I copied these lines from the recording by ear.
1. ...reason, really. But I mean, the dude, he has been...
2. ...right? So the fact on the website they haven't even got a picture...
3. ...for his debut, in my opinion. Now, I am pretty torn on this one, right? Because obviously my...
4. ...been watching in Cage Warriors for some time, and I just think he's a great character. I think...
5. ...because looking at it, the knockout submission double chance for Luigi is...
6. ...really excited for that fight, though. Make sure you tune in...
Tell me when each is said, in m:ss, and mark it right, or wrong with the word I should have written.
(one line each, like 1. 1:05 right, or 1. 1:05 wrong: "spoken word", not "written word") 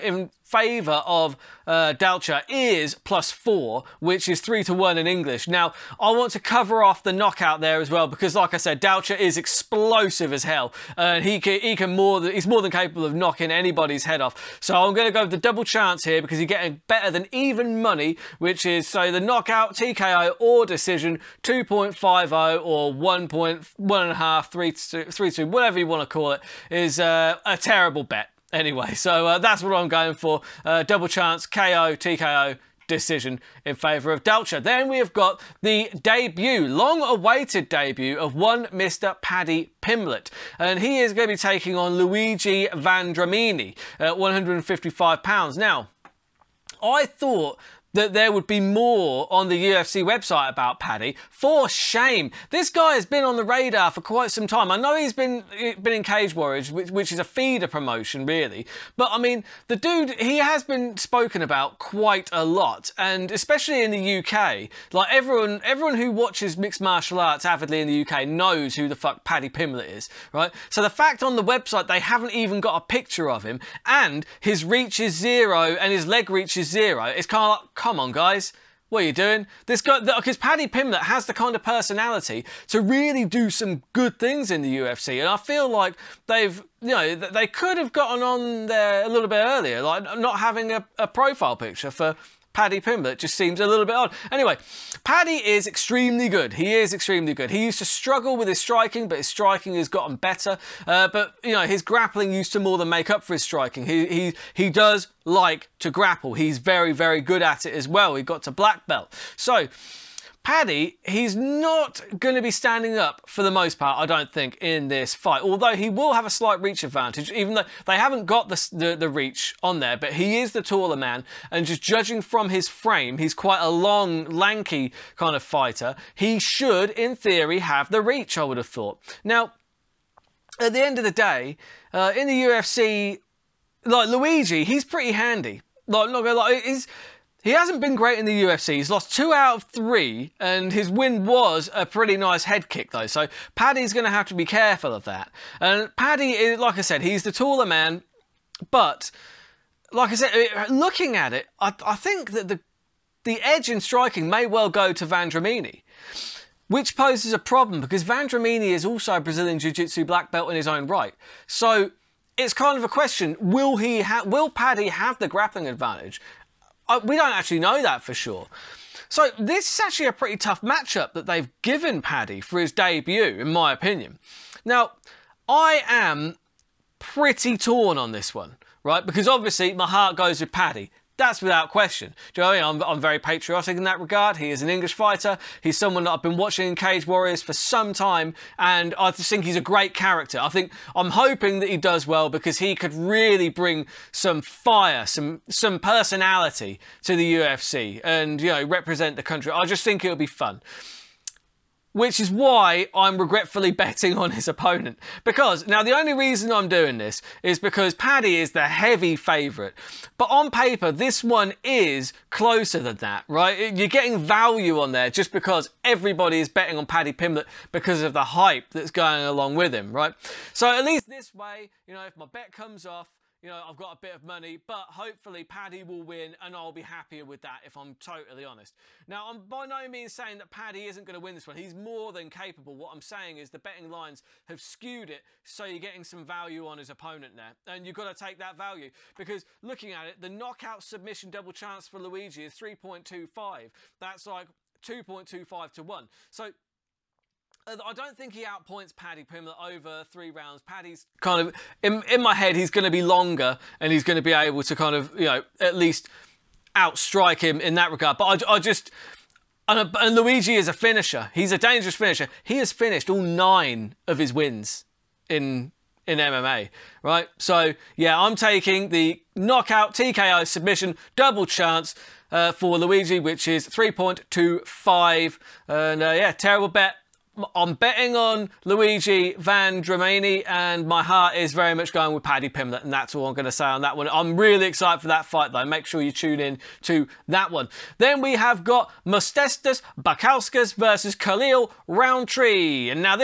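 1. 0:57 wrong: "promotion", not "reason"
2. 1:10 right
3. 2:52 right
4. 3:06 right
5. 3:59 right
6. 4:44 right.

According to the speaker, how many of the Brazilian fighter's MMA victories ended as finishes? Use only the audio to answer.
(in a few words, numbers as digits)
9.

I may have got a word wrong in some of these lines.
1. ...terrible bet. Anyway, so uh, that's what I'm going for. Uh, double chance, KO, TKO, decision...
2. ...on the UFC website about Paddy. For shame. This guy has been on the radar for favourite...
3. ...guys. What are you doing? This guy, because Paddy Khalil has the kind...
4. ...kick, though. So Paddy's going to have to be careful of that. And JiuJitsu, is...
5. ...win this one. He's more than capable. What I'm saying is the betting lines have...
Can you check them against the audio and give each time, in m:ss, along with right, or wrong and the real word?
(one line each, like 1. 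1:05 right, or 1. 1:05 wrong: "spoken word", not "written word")
1. 0:27 right
2. 0:49 wrong: "quite", not "favourite"
3. 1:18 wrong: "Pimblett", not "Khalil"
4. 2:22 wrong: "Paddy", not "JiuJitsu"
5. 3:51 right.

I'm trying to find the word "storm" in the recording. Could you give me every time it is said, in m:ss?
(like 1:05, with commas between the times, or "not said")
not said.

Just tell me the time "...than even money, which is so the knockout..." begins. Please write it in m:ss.
0:17.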